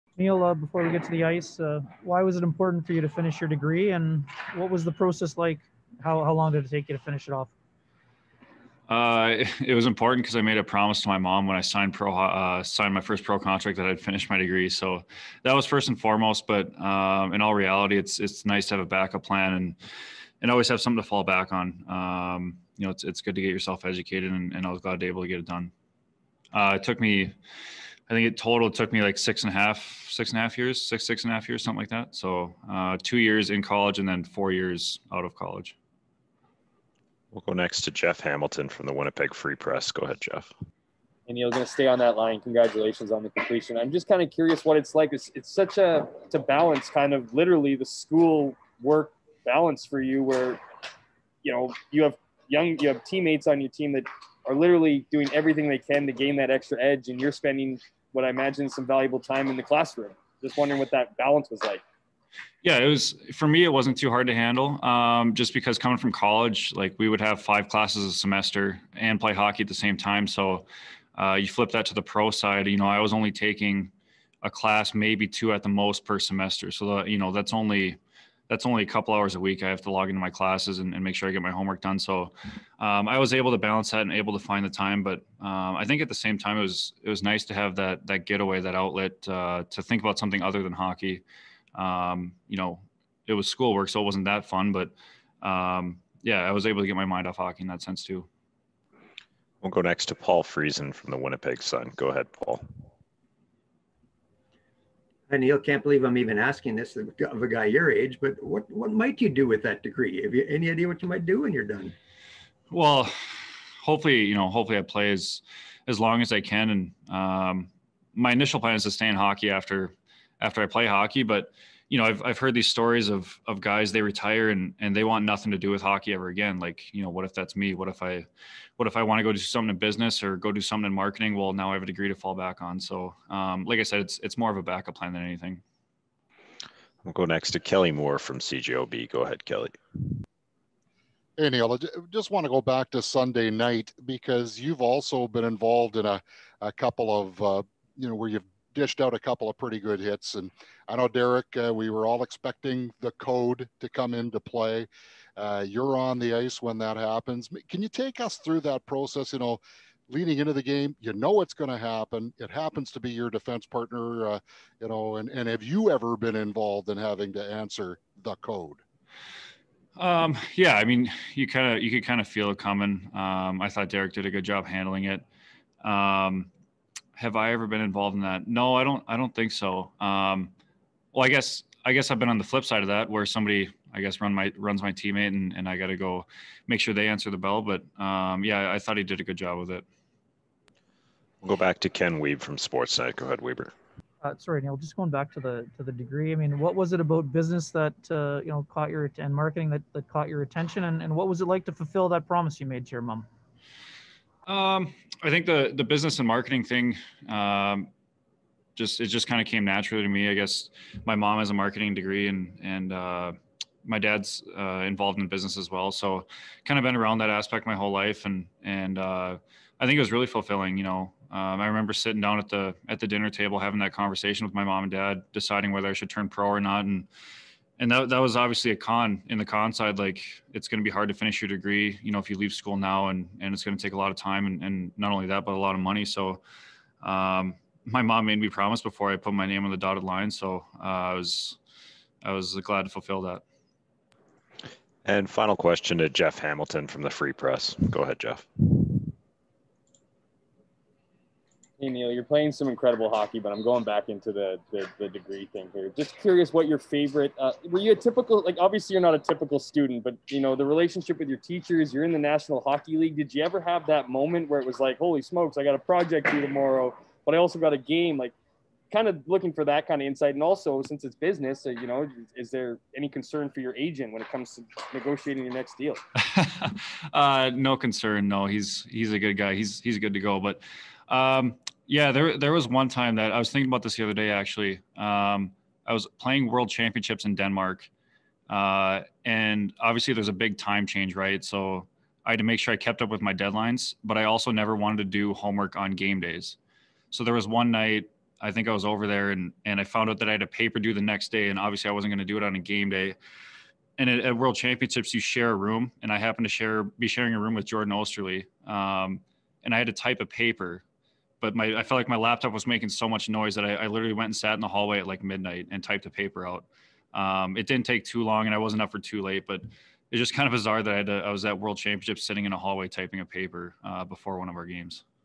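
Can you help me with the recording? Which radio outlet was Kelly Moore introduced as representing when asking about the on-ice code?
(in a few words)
CJOB.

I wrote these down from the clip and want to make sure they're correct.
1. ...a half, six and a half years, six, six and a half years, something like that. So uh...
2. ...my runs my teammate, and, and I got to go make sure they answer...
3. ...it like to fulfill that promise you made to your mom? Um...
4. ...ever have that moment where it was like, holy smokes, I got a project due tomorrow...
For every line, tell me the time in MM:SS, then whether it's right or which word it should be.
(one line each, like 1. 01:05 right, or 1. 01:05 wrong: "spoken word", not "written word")
1. 00:29 right
2. 03:04 right
3. 03:21 right
4. 04:23 right.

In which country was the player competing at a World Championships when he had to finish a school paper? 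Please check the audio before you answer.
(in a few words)
Denmark.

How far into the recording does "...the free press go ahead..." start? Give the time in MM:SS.
04:07.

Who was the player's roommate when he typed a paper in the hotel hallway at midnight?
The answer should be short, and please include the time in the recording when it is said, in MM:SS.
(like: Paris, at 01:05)
Jordan Oesterle, at 05:07.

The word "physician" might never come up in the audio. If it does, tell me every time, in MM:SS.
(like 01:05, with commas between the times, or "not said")
not said.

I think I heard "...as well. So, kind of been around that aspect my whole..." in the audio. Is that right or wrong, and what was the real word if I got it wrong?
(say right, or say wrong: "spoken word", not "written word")
right.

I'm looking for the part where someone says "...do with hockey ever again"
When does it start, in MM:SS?
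02:05.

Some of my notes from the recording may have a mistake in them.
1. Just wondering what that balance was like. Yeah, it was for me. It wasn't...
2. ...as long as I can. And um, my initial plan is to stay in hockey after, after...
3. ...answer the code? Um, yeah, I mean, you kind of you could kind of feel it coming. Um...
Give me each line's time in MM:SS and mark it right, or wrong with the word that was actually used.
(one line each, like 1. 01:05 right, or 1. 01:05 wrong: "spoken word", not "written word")
1. 01:00 right
2. 01:55 right
3. 02:47 right.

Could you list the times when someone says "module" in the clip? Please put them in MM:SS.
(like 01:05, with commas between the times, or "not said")
not said.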